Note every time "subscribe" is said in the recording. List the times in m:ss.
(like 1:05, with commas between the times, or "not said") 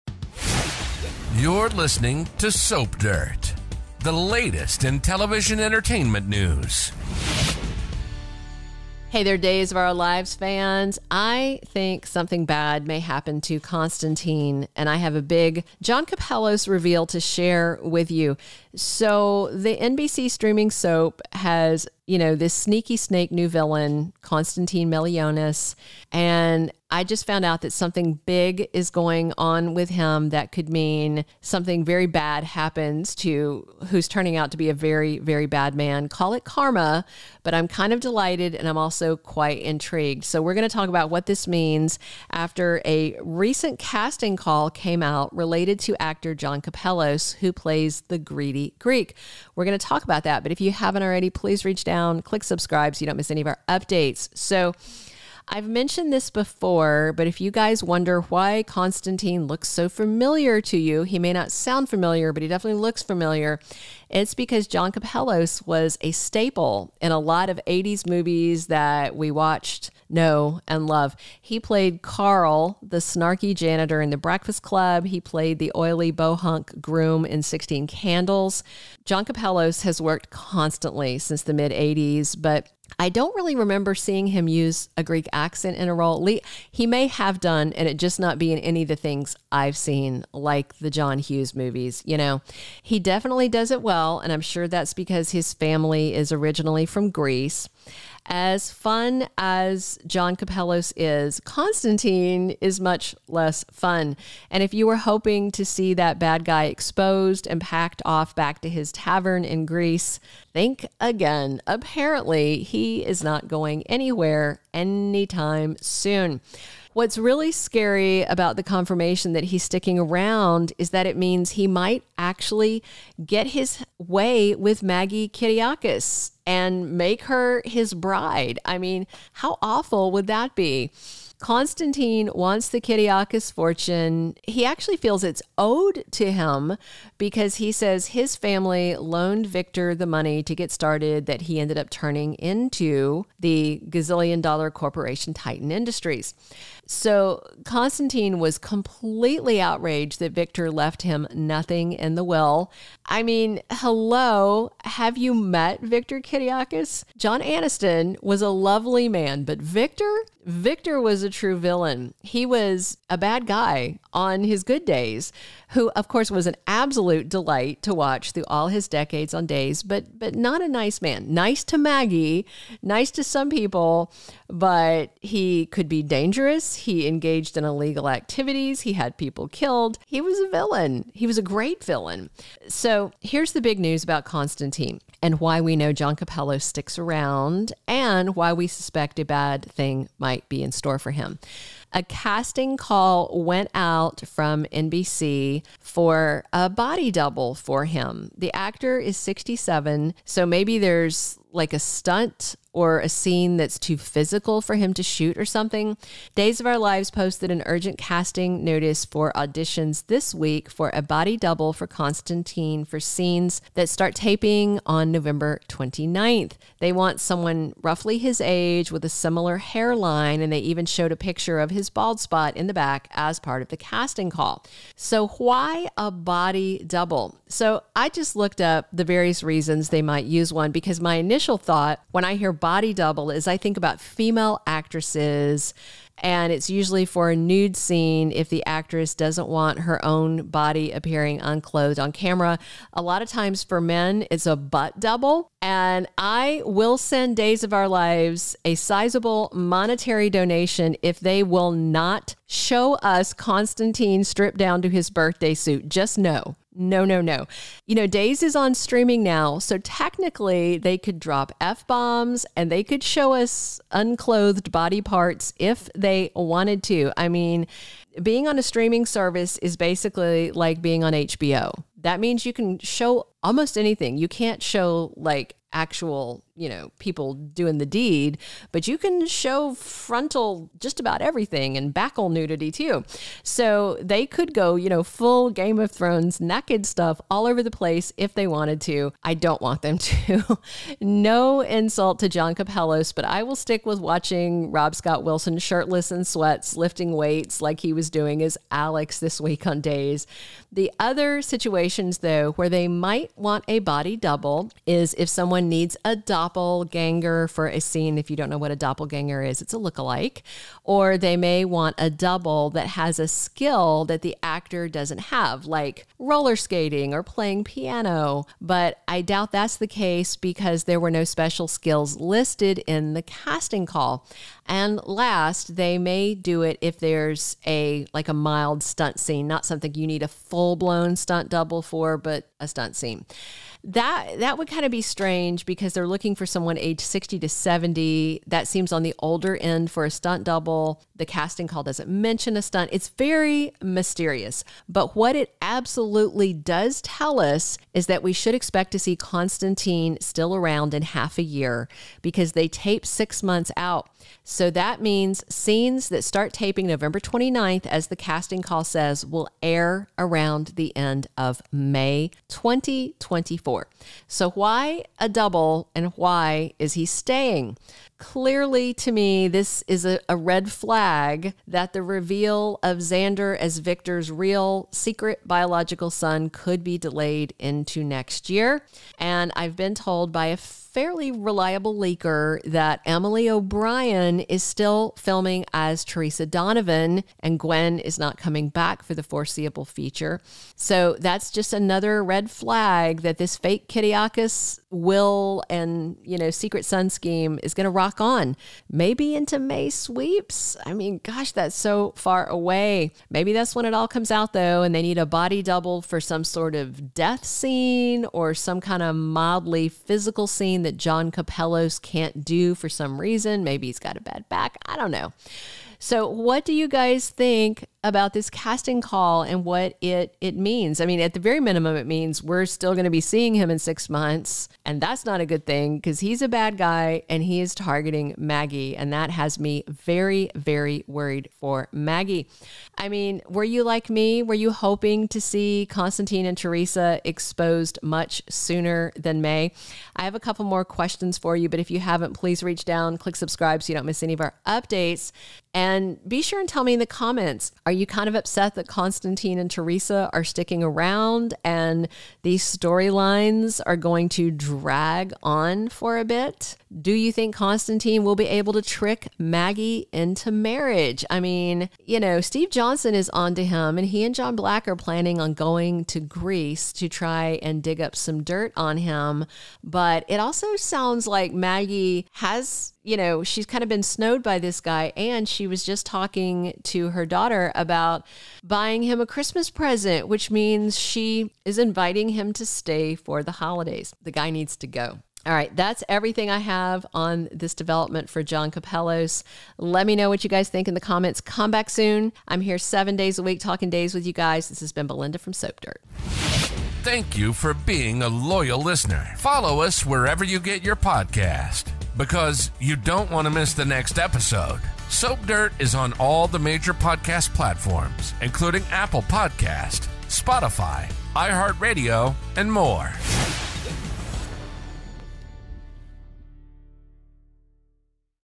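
0:52, 7:23.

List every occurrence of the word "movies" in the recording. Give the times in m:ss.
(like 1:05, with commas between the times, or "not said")
1:08, 1:31.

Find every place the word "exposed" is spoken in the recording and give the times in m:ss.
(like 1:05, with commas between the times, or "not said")
1:46, 7:17.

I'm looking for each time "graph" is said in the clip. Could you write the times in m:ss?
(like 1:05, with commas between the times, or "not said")
not said.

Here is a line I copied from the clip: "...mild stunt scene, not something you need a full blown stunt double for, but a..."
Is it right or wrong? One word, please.
right.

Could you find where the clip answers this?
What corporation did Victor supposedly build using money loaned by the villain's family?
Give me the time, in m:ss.
2:25.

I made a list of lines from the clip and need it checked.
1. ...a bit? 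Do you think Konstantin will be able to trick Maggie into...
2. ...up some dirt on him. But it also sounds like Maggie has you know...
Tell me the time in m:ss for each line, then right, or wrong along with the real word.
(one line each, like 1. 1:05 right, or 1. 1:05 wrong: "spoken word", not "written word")
1. 7:36 right
2. 7:48 right.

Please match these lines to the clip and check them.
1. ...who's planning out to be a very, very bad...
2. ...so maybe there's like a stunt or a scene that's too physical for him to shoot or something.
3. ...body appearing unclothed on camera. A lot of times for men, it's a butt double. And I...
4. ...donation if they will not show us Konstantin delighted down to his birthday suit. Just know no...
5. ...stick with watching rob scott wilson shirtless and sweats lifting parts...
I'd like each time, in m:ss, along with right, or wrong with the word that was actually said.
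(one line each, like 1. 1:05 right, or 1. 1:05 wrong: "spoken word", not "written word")
1. 0:33 wrong: "turning", not "planning"
2. 3:20 right
3. 4:00 right
4. 4:10 wrong: "stripped", not "delighted"
5. 4:53 wrong: "weights", not "parts".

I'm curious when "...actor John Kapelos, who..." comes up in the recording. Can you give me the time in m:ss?
0:46.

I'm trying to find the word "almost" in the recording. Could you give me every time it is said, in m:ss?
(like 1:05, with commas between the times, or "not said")
4:33.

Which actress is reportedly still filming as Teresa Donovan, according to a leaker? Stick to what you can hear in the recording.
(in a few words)
Emily O'Brien.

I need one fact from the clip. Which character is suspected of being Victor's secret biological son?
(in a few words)
Xander.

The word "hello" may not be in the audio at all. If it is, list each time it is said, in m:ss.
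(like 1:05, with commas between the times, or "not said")
2:33.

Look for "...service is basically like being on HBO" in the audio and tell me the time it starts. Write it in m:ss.
4:29.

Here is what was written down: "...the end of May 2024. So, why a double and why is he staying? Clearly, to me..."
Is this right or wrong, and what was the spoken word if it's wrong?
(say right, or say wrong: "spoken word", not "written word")
right.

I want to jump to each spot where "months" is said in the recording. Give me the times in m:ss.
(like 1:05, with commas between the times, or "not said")
5:53, 7:04.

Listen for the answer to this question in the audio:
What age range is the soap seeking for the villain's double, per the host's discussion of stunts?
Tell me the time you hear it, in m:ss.
5:37.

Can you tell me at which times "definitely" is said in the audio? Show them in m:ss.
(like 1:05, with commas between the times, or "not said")
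1:02, 1:32.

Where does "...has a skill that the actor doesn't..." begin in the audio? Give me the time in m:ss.
5:12.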